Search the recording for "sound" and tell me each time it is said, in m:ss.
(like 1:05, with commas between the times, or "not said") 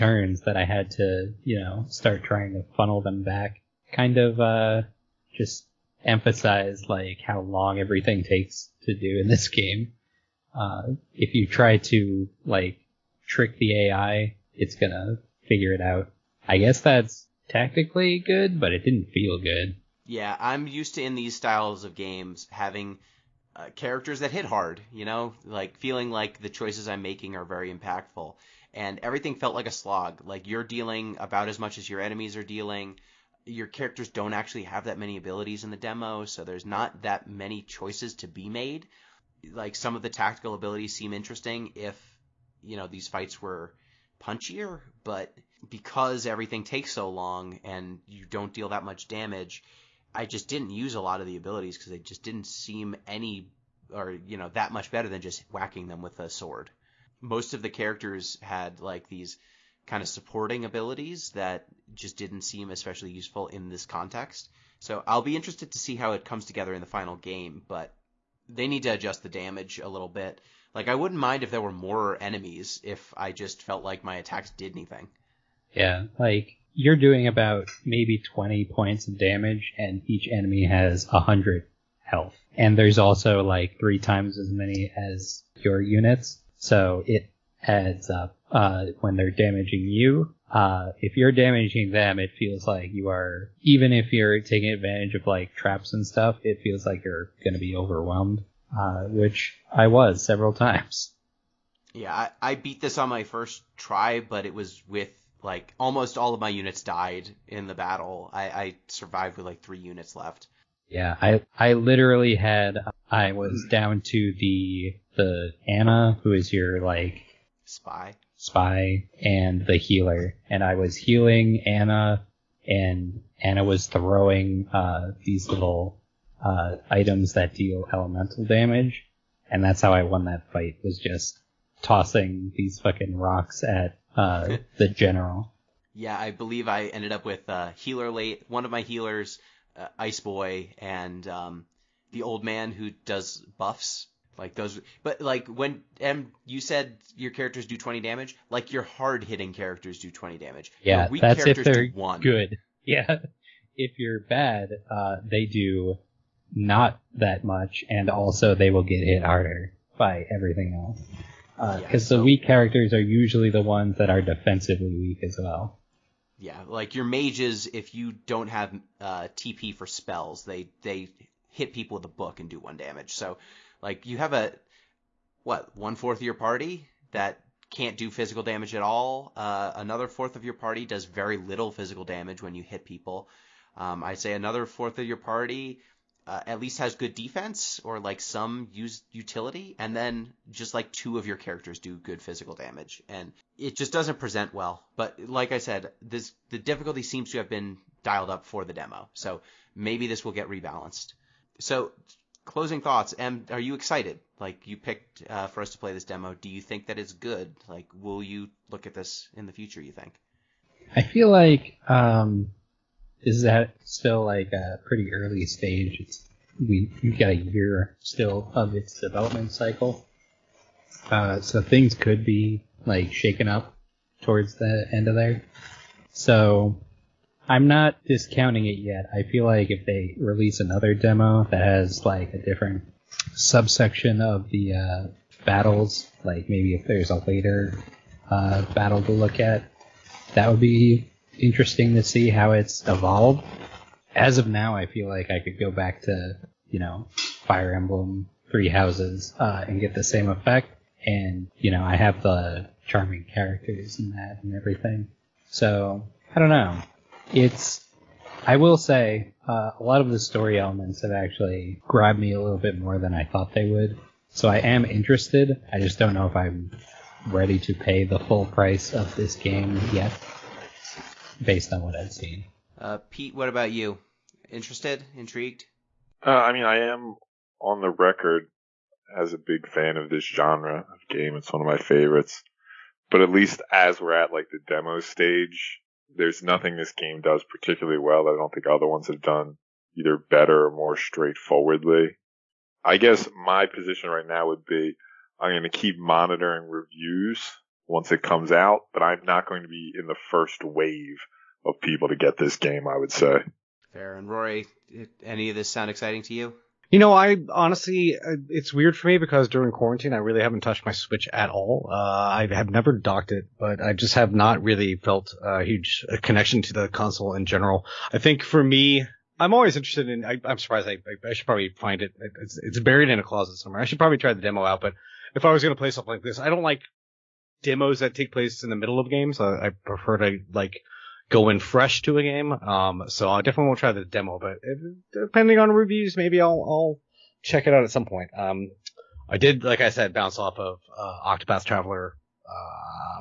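5:05.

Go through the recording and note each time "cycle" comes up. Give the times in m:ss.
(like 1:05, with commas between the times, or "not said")
3:39.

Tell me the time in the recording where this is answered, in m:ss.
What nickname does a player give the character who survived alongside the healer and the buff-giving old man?
2:19.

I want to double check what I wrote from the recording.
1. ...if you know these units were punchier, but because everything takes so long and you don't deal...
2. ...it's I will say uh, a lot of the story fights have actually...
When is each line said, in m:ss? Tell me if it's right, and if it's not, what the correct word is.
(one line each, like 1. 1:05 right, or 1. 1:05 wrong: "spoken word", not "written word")
1. 0:41 wrong: "fights", not "units"
2. 4:17 wrong: "elements", not "fights".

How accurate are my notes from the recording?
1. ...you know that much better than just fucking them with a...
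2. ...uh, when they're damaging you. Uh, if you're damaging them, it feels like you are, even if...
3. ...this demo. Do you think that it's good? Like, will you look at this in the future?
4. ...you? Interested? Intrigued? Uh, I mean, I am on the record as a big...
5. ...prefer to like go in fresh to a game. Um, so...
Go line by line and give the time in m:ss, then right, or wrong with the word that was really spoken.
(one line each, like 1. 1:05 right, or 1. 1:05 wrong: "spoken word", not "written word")
1. 0:54 wrong: "whacking", not "fucking"
2. 1:28 right
3. 3:25 right
4. 4:33 right
5. 5:29 right.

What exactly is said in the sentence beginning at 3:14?
But like I said, this the difficulty seems to have been dialed up for the demo, so maybe this will get rebalanced.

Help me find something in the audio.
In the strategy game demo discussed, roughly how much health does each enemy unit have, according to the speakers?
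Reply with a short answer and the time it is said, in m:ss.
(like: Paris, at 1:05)
100, at 1:21.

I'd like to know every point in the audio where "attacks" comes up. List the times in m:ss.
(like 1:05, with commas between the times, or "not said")
1:14.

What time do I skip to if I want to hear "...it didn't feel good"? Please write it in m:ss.
0:18.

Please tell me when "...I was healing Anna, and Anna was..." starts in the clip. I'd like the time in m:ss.
2:00.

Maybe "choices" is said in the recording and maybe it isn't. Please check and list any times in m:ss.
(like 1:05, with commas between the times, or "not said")
0:26, 0:37.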